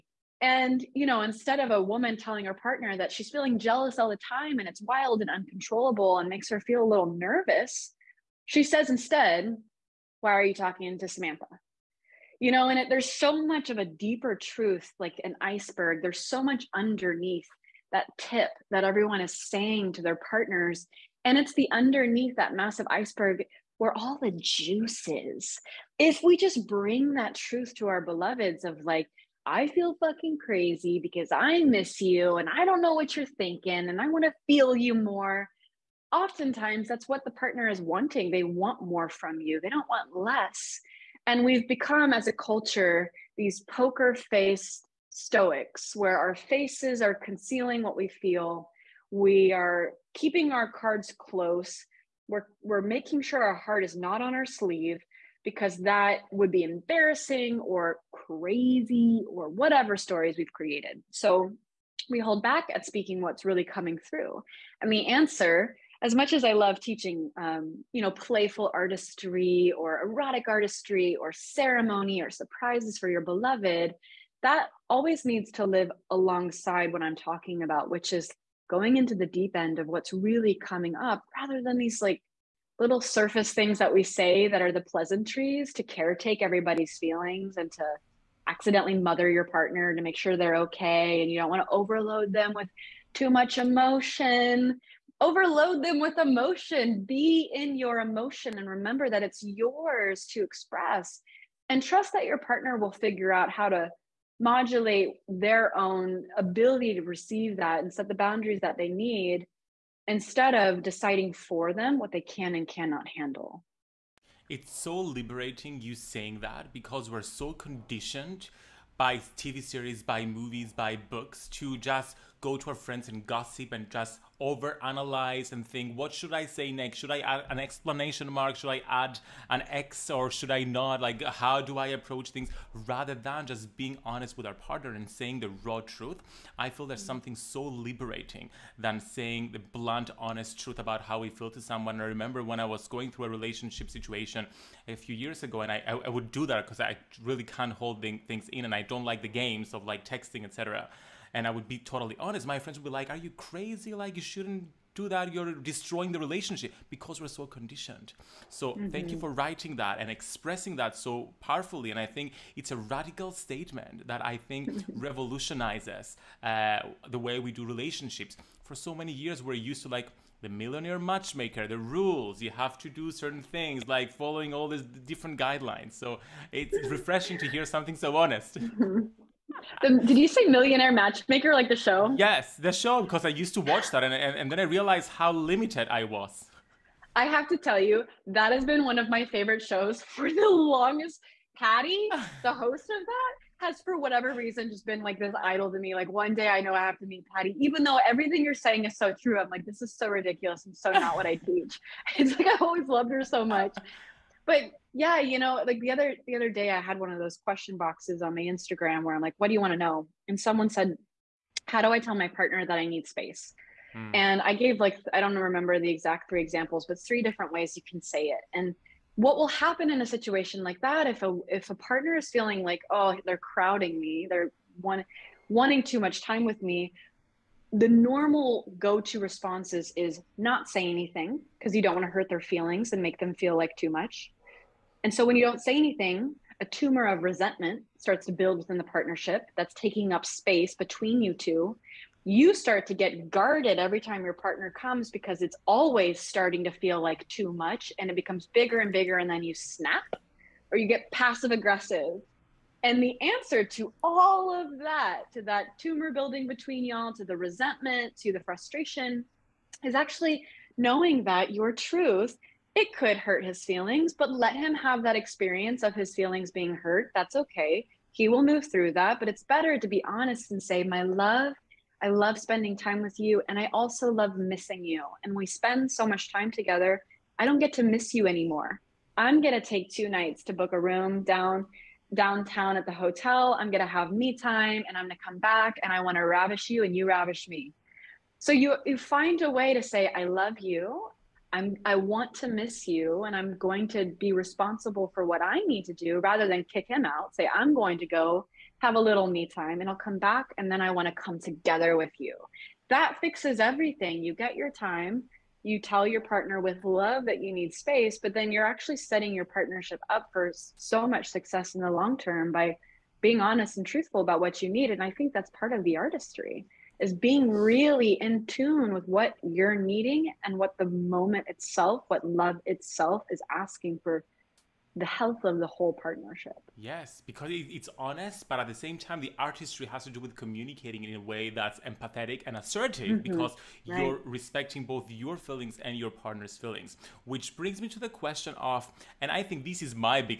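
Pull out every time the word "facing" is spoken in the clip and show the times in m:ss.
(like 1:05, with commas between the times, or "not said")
not said.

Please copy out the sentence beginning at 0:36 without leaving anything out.
Oftentimes, that's what the partner is wanting.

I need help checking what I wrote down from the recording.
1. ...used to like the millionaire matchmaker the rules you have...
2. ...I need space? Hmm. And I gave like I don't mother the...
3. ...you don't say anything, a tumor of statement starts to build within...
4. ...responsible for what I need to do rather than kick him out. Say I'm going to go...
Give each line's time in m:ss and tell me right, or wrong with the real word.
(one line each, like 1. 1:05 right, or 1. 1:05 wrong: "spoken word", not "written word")
1. 2:49 right
2. 3:32 wrong: "remember", not "mother"
3. 3:55 wrong: "resentment", not "statement"
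4. 4:54 right.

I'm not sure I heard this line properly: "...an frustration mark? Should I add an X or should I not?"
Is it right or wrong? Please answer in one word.
wrong.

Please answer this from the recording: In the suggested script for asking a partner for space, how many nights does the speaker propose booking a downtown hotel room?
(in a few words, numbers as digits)
2.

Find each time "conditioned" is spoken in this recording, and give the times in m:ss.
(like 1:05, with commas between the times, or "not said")
1:57, 2:37.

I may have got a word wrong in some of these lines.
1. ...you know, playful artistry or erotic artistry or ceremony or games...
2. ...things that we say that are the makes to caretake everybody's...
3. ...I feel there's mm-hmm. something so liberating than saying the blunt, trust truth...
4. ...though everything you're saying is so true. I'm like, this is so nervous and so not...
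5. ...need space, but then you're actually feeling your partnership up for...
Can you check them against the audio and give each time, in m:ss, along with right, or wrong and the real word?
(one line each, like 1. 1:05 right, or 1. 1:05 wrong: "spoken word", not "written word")
1. 1:07 wrong: "surprises", not "games"
2. 1:23 wrong: "pleasantries", not "makes"
3. 2:16 wrong: "honest", not "trust"
4. 3:17 wrong: "ridiculous", not "nervous"
5. 5:07 wrong: "setting", not "feeling".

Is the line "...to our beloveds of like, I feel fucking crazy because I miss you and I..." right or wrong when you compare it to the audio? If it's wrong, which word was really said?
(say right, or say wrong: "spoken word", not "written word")
right.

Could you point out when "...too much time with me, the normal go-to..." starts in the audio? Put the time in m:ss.
3:45.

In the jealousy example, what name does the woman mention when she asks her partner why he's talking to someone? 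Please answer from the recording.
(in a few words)
Samantha.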